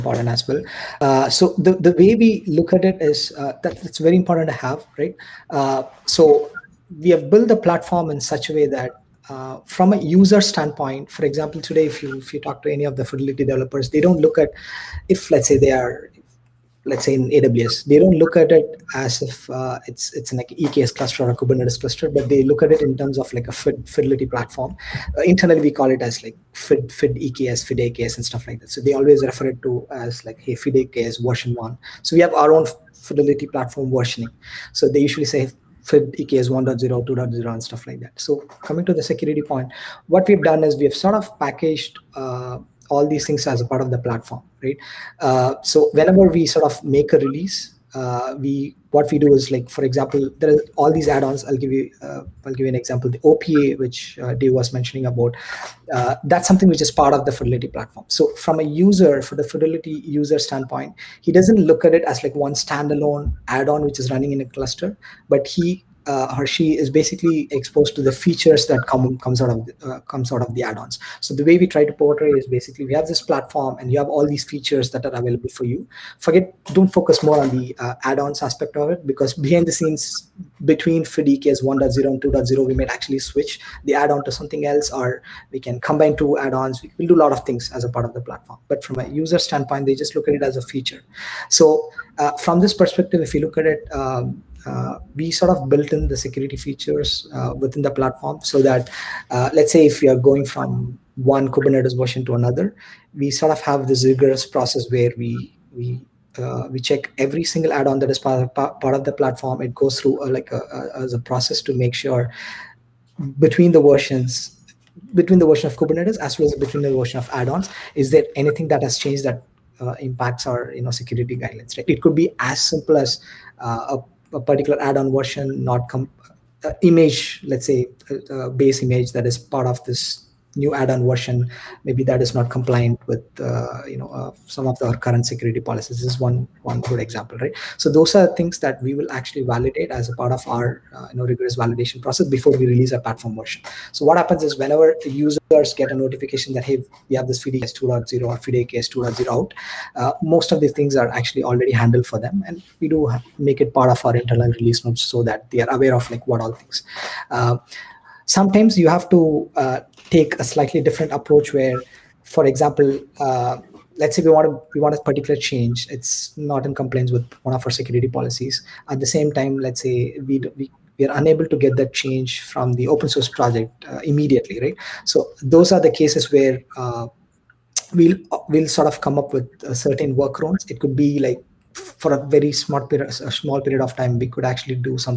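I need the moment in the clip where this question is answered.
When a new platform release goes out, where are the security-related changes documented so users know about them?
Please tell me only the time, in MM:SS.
02:34.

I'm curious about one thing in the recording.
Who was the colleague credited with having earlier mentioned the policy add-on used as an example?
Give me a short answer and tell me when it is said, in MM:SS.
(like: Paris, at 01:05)
Dave, at 00:54.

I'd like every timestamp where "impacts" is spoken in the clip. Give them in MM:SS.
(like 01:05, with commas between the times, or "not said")
02:00.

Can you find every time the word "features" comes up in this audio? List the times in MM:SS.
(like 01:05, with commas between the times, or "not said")
01:08, 01:14, 01:30, 01:36.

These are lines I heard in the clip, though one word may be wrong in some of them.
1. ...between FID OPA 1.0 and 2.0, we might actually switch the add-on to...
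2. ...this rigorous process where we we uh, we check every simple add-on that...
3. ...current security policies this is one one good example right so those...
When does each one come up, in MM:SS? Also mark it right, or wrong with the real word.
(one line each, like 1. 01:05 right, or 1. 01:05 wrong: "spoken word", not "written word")
1. 01:20 wrong: "EKS", not "OPA"
2. 01:43 wrong: "single", not "simple"
3. 02:14 right.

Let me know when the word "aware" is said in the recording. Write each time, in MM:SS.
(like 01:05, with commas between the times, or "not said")
02:35.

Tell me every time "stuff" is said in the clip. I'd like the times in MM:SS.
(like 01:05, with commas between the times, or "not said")
00:28, 00:37.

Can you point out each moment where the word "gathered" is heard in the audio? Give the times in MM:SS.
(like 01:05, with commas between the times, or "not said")
not said.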